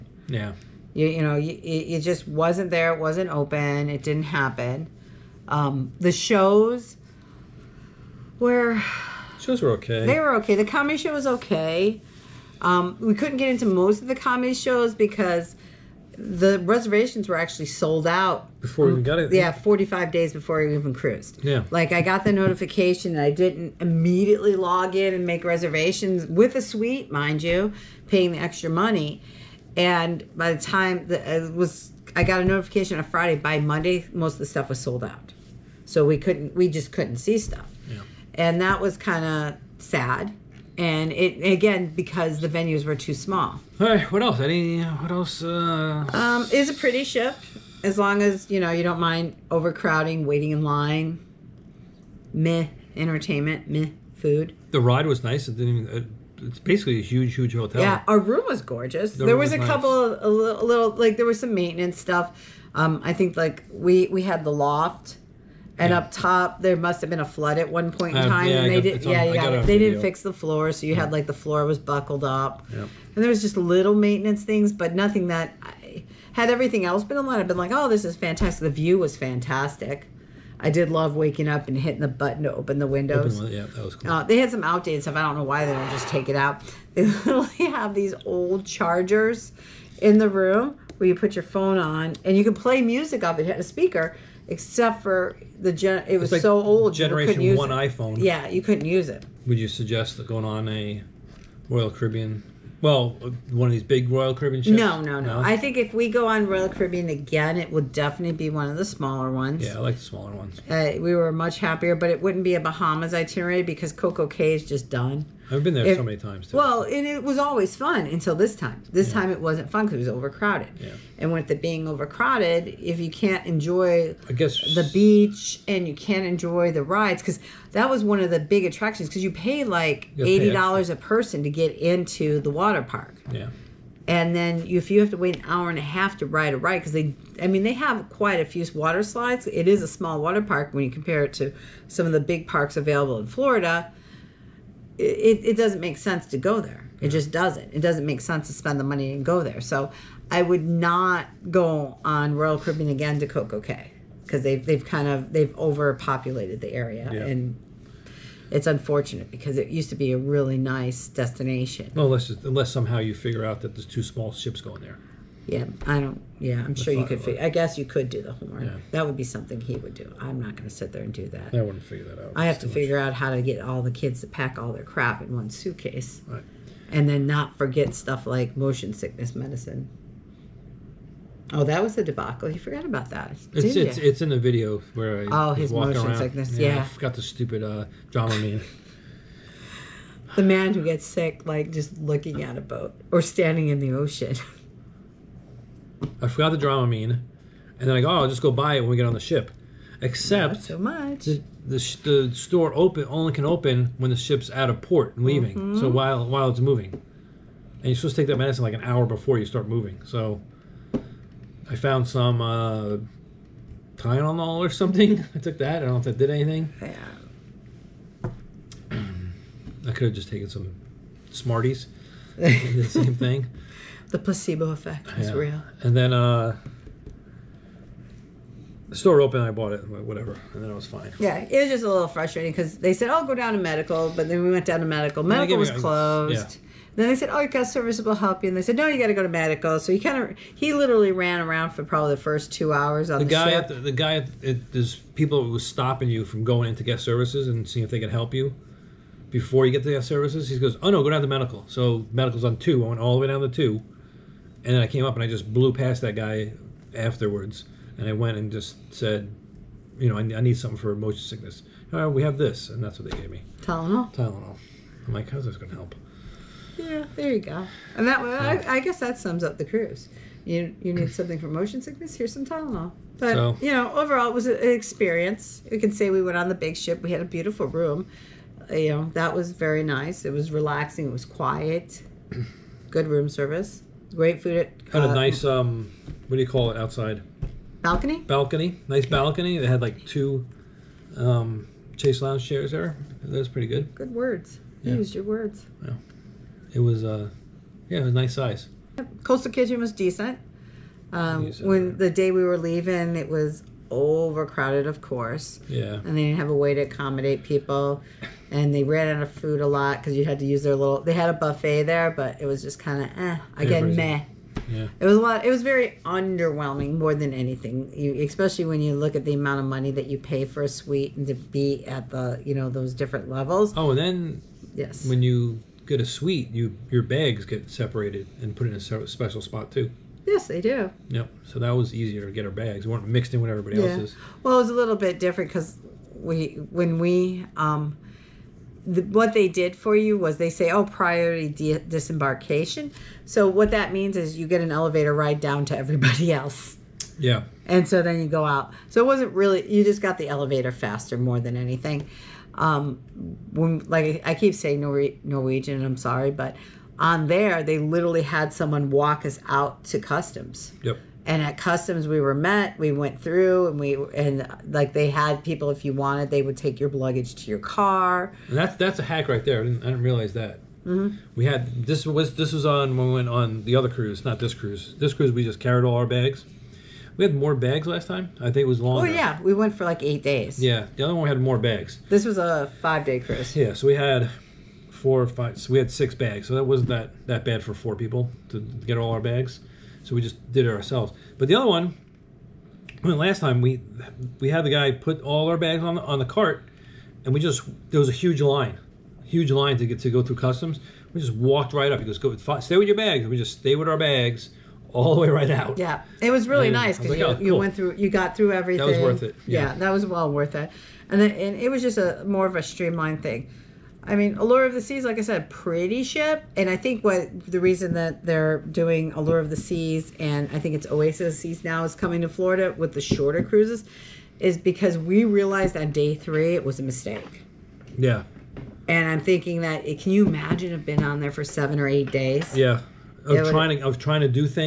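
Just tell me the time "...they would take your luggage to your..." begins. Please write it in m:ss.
6:06.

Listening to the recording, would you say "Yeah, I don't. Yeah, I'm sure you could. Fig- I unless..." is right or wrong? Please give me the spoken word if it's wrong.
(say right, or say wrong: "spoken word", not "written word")
wrong: "guess", not "unless".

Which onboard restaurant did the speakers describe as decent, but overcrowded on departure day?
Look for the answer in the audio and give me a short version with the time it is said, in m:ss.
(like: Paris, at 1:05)
Coastal Kitchen, at 4:59.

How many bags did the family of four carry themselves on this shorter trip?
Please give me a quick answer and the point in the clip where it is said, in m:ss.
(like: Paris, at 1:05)
6, at 6:25.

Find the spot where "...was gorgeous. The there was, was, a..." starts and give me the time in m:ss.
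0:58.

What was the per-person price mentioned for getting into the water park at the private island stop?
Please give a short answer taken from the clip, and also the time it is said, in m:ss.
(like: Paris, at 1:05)
$80, at 2:10.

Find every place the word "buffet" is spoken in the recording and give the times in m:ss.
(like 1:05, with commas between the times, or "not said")
5:11.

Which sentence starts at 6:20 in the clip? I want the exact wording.
Yeah, the other one had more bags.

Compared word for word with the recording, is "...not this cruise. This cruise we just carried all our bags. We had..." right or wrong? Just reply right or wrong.
right.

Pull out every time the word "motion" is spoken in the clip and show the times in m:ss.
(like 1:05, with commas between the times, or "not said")
2:58, 3:05, 4:20, 4:31.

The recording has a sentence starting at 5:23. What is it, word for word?
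Oh, and then yes, when you get a suite, you your bags get separated and put in a special spot too.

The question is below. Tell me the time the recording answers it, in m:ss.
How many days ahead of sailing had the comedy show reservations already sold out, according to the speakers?
0:19.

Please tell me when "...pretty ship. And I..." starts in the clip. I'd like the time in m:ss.
6:55.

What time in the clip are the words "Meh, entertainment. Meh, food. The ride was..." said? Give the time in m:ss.
0:52.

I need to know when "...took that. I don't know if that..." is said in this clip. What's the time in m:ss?
3:35.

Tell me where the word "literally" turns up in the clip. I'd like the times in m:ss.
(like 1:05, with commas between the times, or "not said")
1:27, 4:00, 5:57.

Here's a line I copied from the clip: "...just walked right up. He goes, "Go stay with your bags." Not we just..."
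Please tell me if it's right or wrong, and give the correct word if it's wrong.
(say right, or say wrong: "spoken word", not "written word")
wrong: "And", not "Not".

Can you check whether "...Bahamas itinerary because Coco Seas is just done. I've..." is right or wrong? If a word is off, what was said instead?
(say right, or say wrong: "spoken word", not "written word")
wrong: "Cay", not "Seas".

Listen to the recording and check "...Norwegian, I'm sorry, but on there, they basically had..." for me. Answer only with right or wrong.
wrong.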